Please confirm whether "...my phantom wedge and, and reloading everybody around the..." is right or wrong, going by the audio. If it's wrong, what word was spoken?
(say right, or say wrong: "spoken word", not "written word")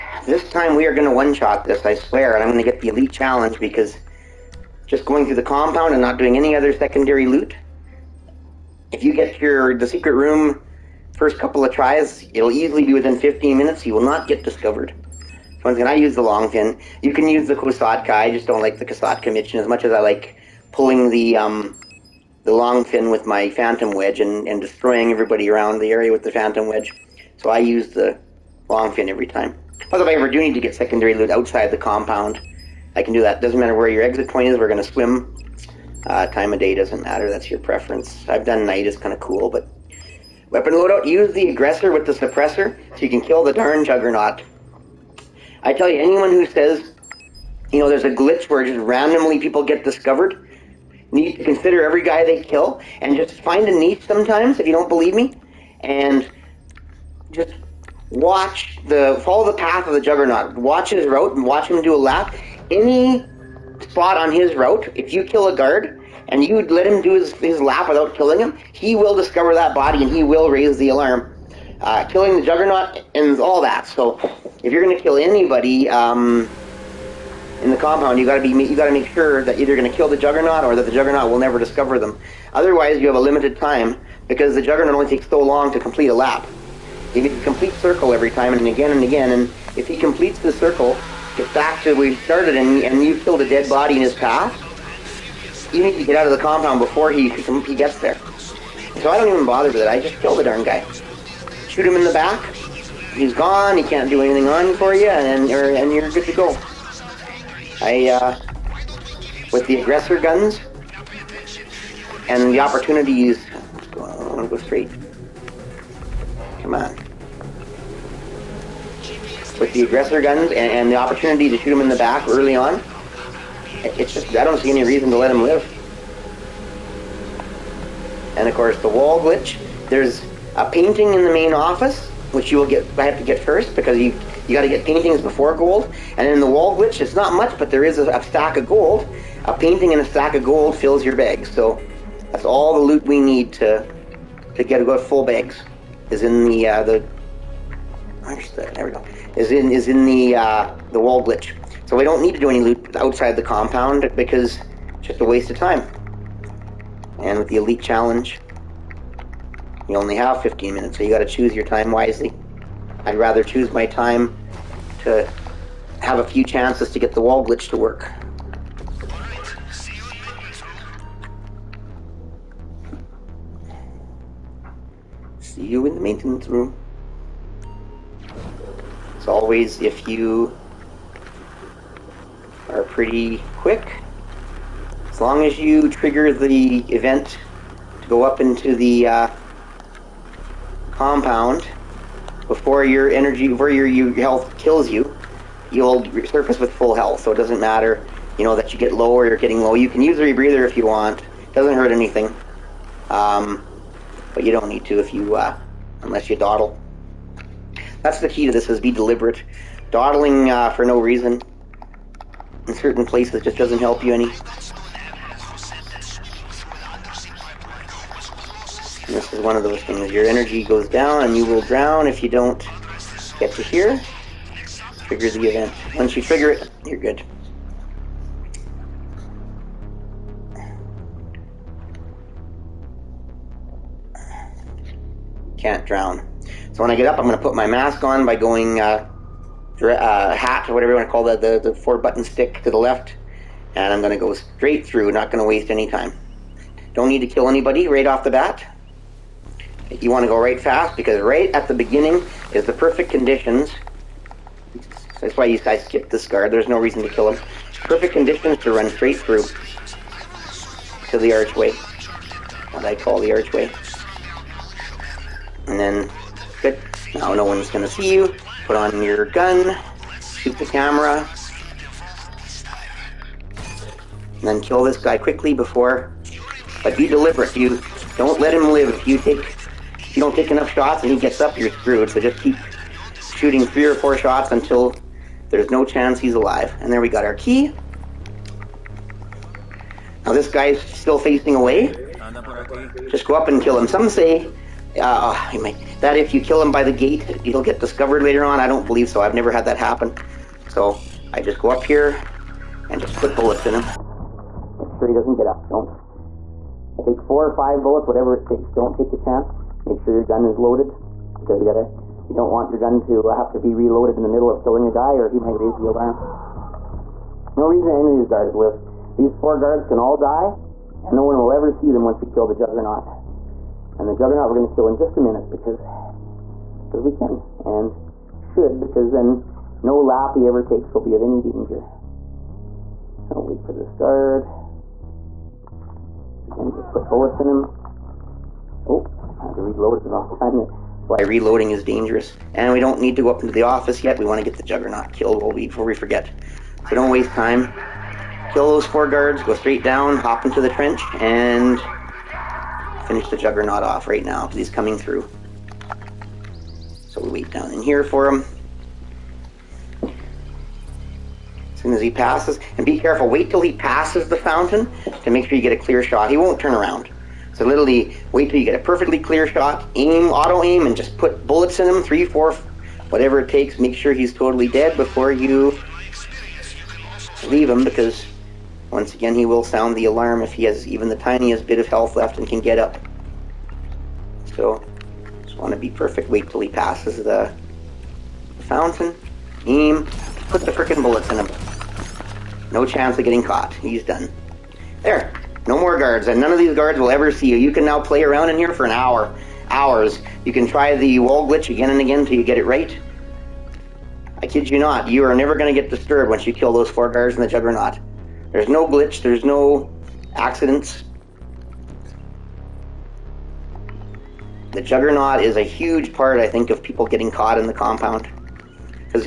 wrong: "destroying", not "reloading".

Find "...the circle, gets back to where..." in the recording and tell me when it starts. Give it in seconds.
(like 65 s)
90 s.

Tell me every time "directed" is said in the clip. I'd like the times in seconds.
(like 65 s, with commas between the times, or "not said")
not said.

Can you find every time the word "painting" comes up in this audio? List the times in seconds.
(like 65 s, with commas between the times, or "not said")
130 s, 134 s, 139 s.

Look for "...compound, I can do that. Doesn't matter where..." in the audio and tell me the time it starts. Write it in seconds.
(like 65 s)
31 s.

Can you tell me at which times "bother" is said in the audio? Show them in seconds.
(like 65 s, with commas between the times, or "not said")
99 s.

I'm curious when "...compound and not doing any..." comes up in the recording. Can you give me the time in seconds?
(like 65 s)
5 s.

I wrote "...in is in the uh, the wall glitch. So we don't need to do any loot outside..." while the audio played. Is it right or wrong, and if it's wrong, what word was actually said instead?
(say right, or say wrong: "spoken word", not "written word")
right.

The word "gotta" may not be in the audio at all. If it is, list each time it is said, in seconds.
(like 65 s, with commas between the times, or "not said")
311 s.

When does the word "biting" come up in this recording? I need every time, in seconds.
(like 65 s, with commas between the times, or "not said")
not said.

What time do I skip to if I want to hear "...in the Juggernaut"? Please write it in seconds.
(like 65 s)
407 s.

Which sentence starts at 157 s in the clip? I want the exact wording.
And with the elite challenge, you only have 15 minutes, so you got to choose your time wisely.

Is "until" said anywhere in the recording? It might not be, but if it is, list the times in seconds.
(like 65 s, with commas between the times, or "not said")
284 s.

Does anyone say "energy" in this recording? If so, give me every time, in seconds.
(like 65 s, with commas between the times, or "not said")
193 s, 220 s.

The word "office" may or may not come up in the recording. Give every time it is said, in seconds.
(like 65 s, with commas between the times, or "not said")
131 s, 343 s.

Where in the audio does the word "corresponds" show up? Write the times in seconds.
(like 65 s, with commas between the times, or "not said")
not said.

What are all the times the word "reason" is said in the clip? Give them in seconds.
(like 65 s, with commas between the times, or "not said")
124 s, 210 s, 256 s, 317 s.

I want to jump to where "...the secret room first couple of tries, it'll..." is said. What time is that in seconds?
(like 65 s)
9 s.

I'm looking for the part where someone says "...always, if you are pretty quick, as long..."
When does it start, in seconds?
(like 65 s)
179 s.